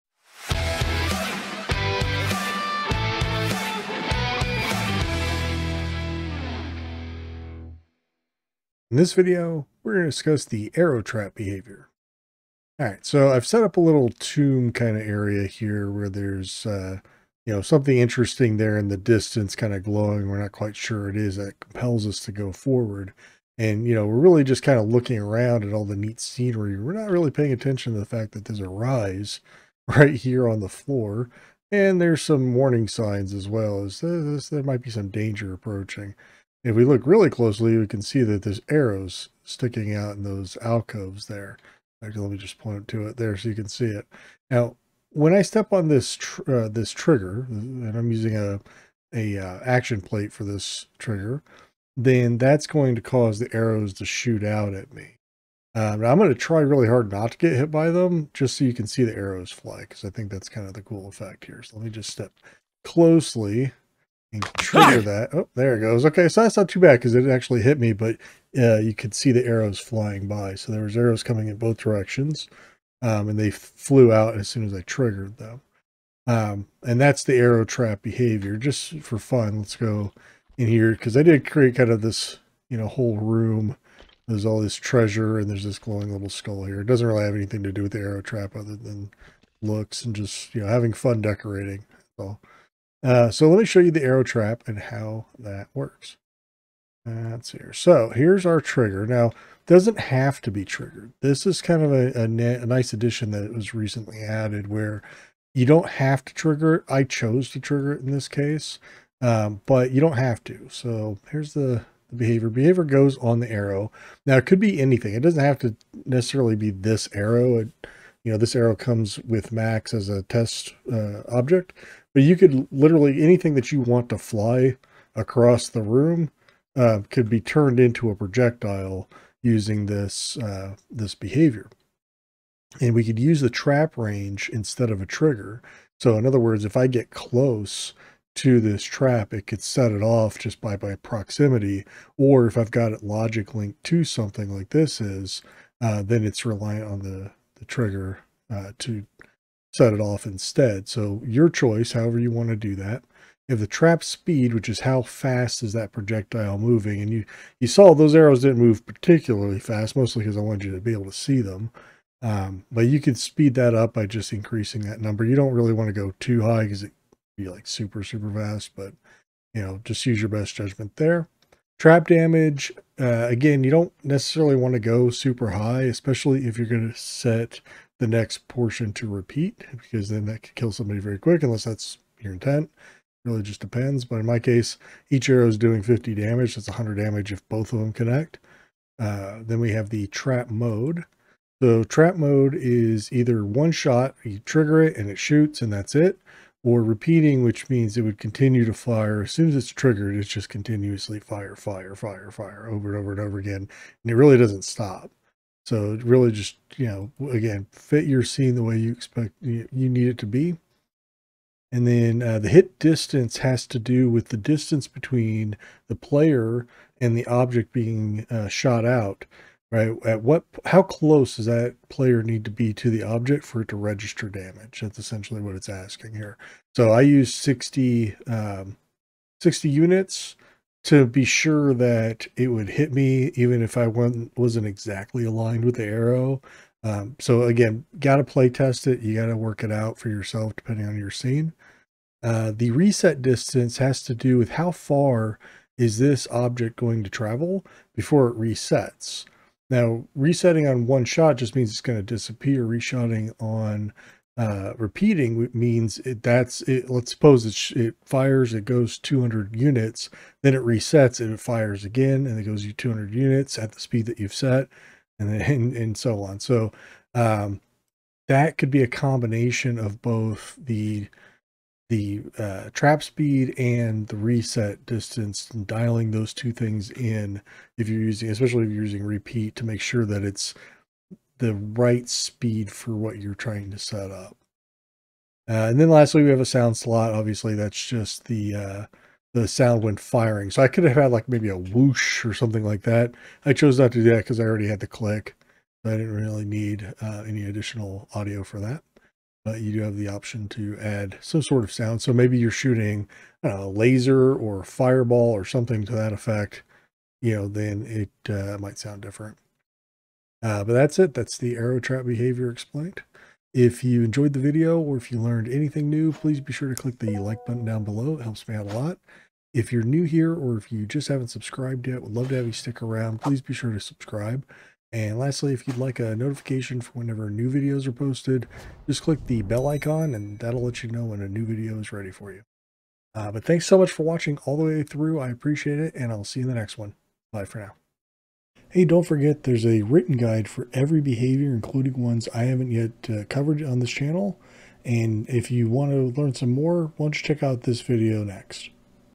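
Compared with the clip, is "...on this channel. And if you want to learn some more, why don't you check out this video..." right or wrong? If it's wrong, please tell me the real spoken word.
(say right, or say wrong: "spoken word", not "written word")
right.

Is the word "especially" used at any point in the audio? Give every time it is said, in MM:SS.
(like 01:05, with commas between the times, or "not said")
02:55, 04:38.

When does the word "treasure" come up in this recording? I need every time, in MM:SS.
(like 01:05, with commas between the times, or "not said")
01:24.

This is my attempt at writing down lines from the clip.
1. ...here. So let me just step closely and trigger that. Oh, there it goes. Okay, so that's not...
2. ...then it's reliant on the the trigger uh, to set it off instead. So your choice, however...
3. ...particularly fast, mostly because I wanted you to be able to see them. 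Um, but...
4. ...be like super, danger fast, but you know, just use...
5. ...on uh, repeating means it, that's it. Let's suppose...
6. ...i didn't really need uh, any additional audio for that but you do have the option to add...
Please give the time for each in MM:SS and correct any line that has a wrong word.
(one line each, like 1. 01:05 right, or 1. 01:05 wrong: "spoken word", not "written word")
1. 01:01 right
2. 02:26 right
3. 02:38 right
4. 02:47 wrong: "super", not "danger"
5. 04:13 right
6. 04:55 right.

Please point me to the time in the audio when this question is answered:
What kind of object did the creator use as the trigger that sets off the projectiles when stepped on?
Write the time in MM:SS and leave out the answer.
00:49.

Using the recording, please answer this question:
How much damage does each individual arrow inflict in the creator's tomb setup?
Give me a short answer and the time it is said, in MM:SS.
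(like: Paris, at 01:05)
50, at 03:05.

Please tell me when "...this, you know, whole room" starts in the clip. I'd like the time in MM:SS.
01:22.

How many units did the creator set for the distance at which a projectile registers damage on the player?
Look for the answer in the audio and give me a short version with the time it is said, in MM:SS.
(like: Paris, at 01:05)
60, at 03:49.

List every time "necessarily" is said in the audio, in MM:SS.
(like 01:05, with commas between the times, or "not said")
01:56, 02:54.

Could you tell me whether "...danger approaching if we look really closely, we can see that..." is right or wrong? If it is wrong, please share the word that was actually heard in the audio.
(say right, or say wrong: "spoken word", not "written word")
right.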